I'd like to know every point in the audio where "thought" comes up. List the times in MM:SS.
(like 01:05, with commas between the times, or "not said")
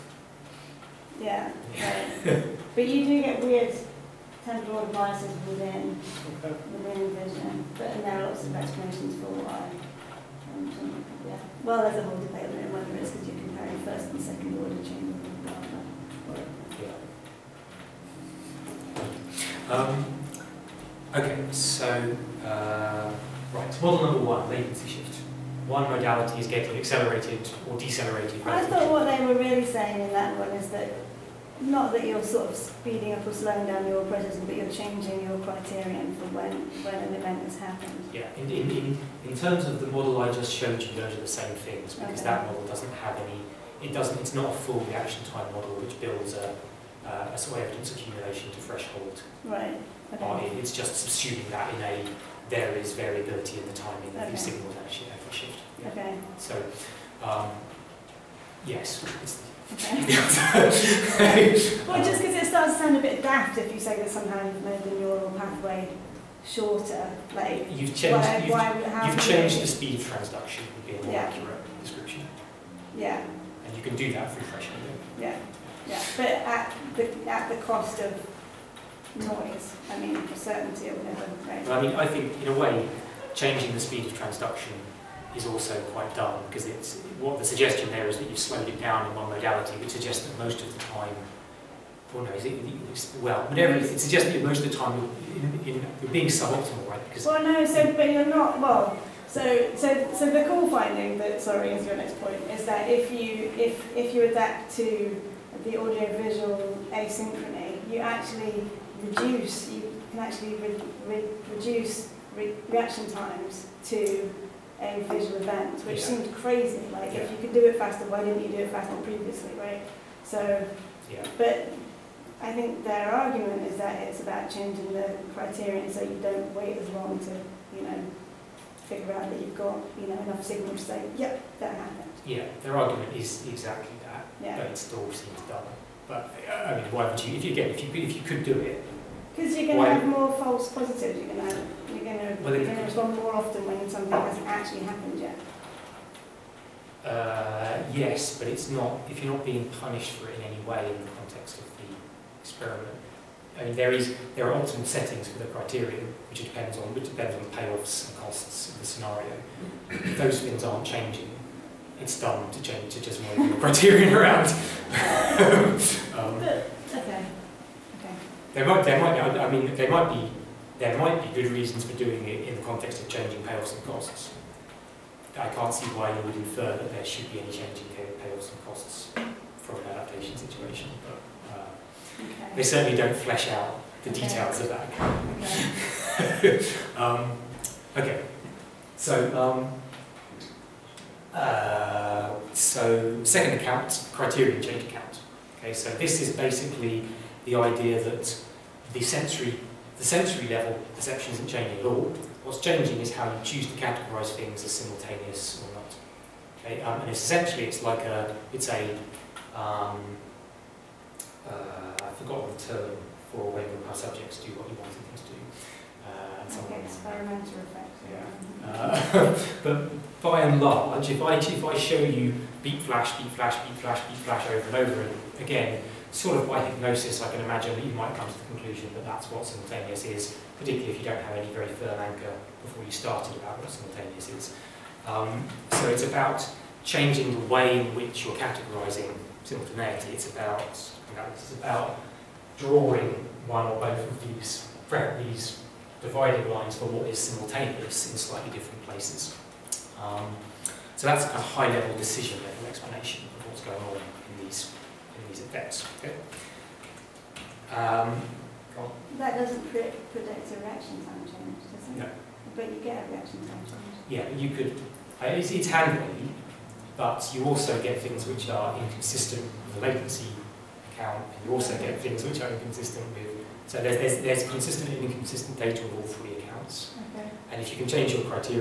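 00:28.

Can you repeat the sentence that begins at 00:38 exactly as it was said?
Yeah, in, in, in, in terms of the model I just showed you, those are the same things because okay.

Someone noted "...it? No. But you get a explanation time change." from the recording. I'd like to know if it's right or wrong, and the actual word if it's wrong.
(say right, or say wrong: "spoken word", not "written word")
wrong: "reaction", not "explanation".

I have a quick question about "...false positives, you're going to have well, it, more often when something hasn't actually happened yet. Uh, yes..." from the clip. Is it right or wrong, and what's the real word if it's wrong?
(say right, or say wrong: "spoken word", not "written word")
right.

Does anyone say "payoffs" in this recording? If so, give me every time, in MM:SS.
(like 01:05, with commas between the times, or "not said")
02:37, 02:53, 02:57.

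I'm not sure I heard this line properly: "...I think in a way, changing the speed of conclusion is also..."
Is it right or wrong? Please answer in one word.
wrong.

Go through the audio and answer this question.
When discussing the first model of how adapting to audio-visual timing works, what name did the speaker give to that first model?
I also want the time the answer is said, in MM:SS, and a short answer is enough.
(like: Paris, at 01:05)
Latency shift, at 00:24.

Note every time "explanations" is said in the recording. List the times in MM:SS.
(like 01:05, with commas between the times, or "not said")
00:08, 04:12.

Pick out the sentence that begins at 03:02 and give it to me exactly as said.
they certainly don't flesh out the details okay.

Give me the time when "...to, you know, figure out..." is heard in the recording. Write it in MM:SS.
02:07.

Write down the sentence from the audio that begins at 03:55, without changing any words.
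Um, so it's about changing the way in which you're categorizing simultaneity.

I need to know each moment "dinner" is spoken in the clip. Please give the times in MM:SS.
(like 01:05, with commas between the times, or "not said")
not said.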